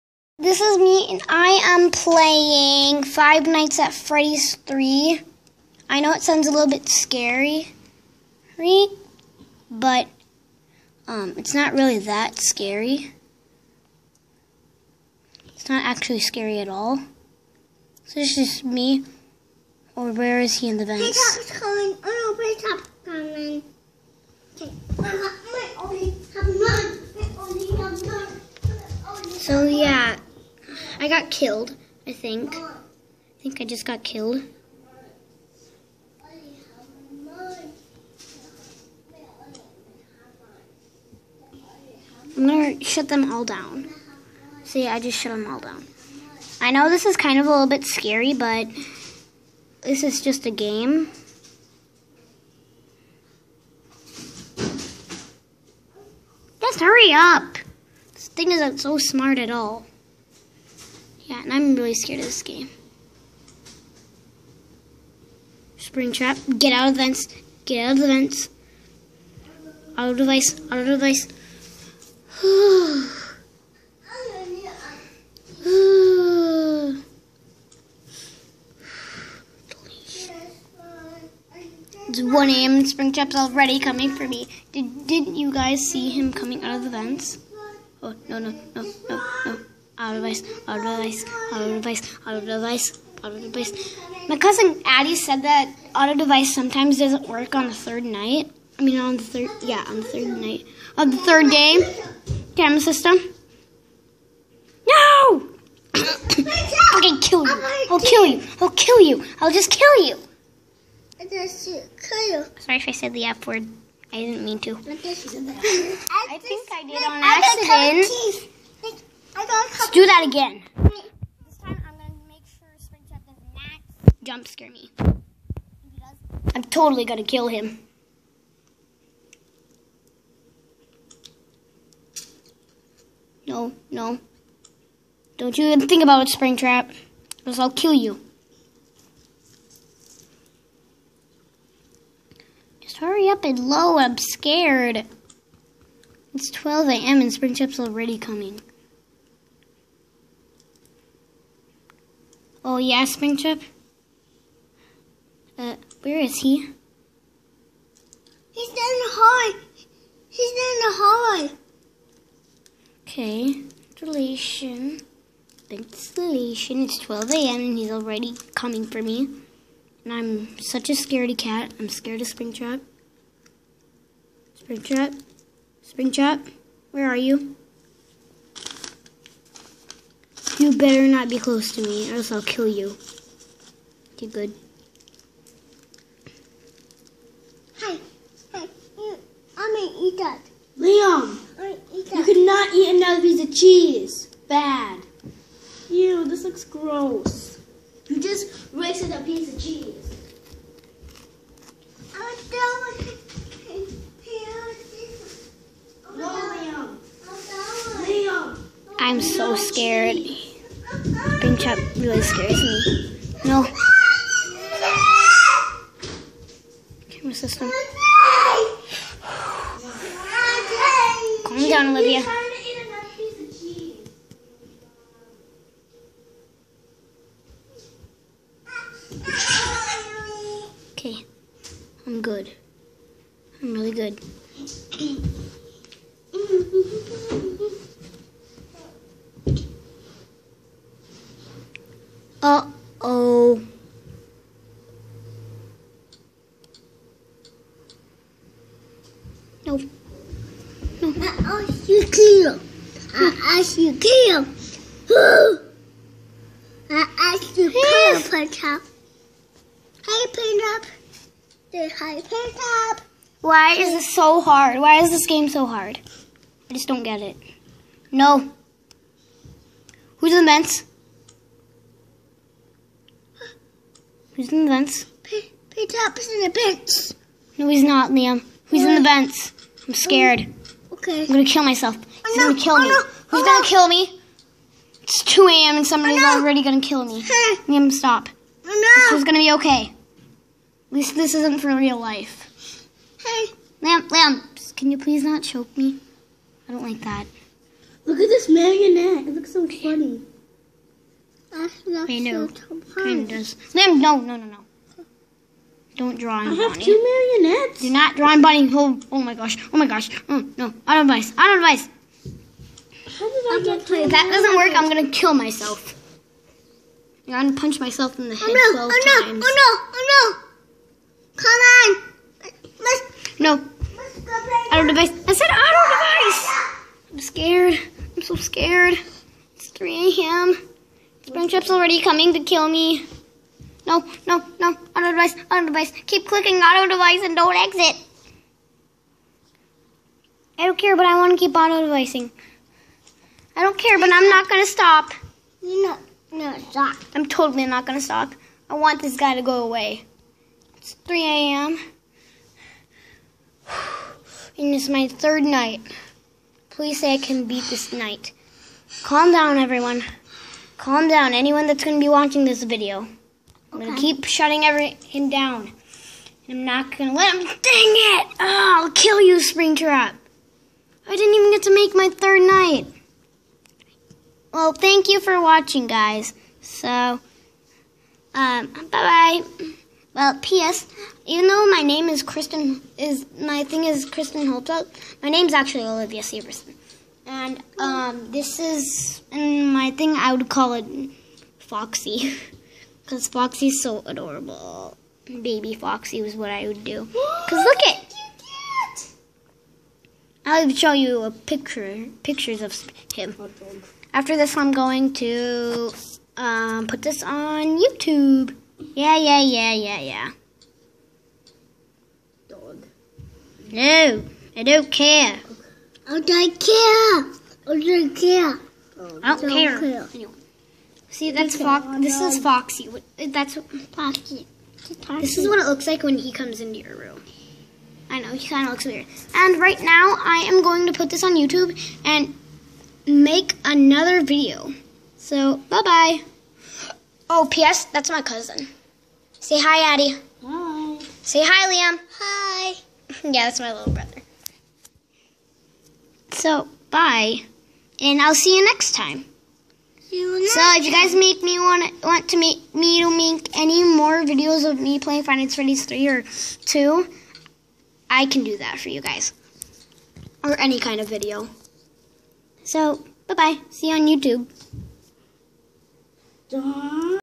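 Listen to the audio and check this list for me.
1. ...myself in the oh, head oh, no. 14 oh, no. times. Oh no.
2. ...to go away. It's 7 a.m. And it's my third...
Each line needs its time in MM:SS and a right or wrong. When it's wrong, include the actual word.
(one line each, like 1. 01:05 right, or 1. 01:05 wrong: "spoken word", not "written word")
1. 05:17 wrong: "12", not "14"
2. 05:49 wrong: "3", not "7".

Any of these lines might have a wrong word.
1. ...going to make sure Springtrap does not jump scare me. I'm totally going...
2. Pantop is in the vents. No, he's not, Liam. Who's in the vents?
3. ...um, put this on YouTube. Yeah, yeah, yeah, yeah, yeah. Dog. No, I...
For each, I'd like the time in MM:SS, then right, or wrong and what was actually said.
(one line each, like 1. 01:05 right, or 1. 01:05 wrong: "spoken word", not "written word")
1. 02:01 right
2. 04:35 right
3. 06:46 right.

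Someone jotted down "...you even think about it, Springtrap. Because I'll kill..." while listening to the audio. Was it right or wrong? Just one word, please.
right.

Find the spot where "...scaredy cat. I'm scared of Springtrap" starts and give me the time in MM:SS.
02:50.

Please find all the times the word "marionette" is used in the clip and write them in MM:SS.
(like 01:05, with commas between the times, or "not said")
04:58, 05:07.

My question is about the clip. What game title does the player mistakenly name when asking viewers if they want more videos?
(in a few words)
Final Fantasy 3.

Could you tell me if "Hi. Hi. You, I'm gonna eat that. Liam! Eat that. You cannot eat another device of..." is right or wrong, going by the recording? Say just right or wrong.
wrong.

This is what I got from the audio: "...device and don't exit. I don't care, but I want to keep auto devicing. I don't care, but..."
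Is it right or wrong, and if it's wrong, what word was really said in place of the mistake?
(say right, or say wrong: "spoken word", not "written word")
right.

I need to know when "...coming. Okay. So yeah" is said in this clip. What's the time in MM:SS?
00:28.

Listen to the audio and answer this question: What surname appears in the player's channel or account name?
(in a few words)
Hofeldt.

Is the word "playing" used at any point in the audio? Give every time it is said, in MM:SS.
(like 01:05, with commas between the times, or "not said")
00:01, 07:34.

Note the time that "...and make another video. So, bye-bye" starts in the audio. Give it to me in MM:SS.
07:12.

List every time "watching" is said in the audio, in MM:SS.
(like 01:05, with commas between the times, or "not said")
06:02, 06:15.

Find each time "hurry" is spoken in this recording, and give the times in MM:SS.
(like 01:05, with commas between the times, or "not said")
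00:56, 02:22.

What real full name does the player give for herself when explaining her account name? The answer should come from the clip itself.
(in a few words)
Olivia Severson.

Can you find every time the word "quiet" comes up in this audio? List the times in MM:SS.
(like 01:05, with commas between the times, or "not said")
not said.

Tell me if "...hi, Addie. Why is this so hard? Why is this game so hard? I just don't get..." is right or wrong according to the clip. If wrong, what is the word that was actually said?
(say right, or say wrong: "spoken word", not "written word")
wrong: "Pantop", not "Addie".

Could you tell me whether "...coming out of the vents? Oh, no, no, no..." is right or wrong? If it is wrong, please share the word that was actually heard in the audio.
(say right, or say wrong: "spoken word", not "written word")
right.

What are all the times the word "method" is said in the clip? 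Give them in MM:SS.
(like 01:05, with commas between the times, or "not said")
not said.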